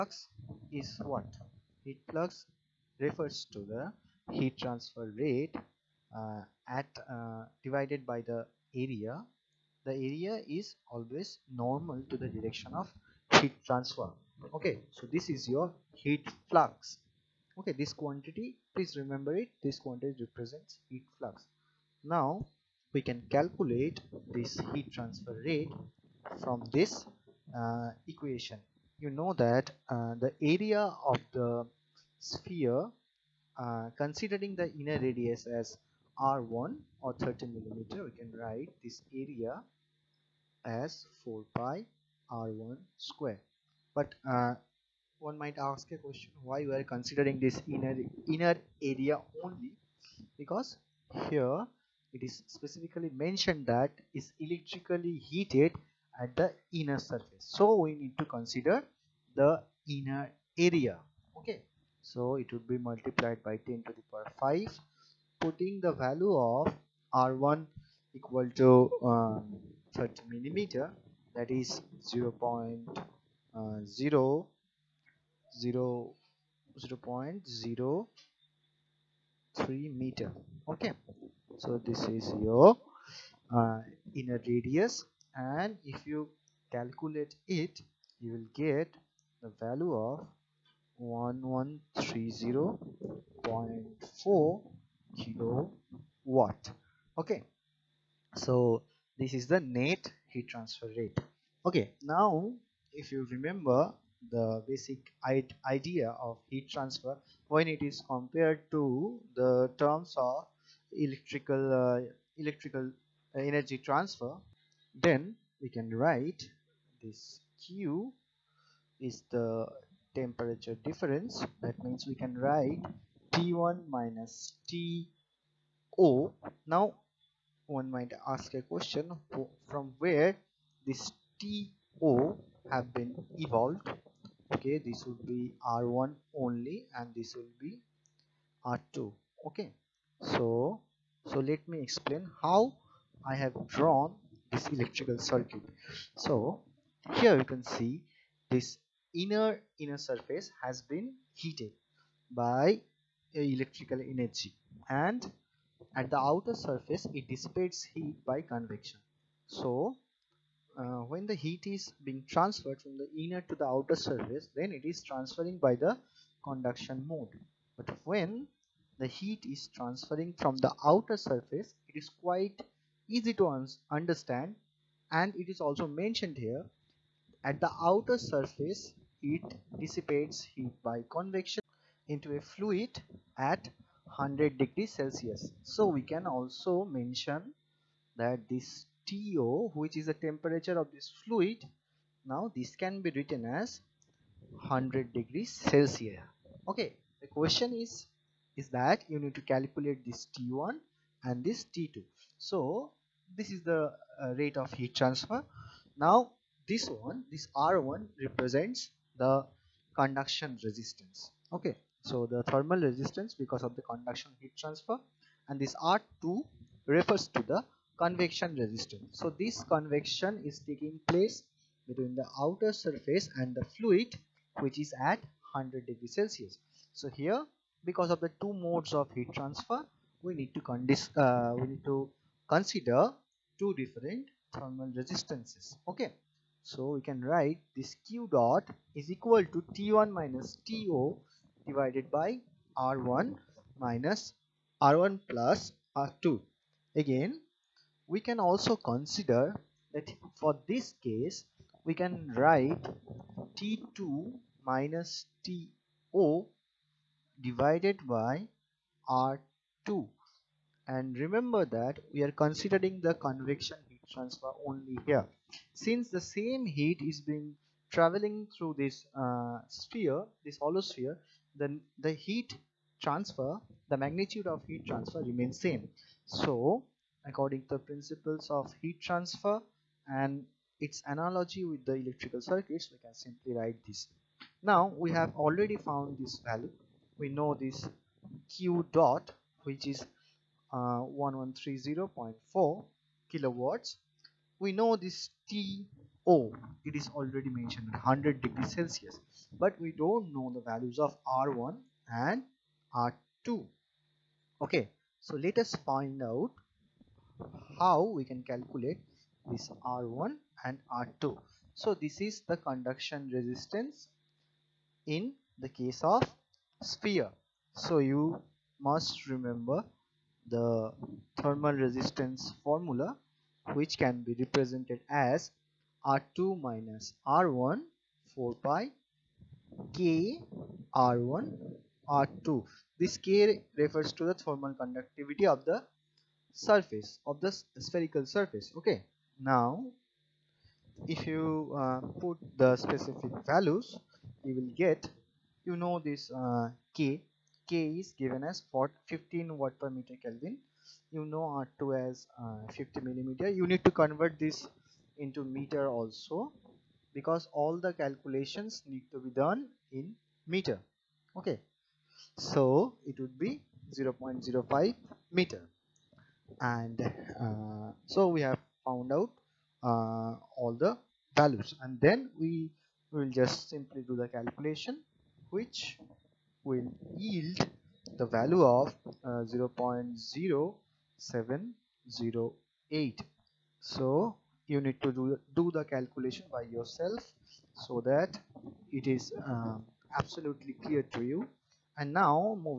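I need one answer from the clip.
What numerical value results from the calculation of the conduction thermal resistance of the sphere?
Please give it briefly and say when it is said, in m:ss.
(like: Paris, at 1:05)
0.0708, at 6:21.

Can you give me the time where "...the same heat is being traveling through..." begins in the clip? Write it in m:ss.
4:26.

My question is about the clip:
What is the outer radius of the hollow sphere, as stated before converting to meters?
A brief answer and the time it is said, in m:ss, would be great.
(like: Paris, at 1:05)
50 millimeters, at 5:52.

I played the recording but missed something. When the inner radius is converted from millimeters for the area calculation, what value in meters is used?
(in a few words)
0.03 meters.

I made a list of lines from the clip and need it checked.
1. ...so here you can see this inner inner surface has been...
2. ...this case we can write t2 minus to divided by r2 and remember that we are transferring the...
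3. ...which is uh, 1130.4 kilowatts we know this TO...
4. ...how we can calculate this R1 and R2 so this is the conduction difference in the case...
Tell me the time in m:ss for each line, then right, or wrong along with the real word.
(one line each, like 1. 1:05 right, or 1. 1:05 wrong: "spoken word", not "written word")
1. 2:26 right
2. 4:10 wrong: "considering", not "transferring"
3. 4:49 right
4. 5:07 wrong: "resistance", not "difference".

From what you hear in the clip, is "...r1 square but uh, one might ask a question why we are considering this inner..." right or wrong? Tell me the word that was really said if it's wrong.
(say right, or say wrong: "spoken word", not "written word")
right.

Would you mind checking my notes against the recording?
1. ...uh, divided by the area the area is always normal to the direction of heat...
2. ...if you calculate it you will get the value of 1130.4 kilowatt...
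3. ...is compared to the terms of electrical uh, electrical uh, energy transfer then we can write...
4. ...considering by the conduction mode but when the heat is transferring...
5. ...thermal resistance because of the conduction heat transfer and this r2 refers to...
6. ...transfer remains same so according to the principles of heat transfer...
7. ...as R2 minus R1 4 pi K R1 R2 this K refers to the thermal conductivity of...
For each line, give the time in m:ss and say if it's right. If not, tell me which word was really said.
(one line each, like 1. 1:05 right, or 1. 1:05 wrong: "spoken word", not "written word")
1. 0:07 right
2. 1:25 right
3. 1:47 right
4. 2:45 wrong: "transferring", not "considering"
5. 3:32 right
6. 4:34 right
7. 5:25 right.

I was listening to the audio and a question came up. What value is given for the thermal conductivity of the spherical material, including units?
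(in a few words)
15 W/m·K.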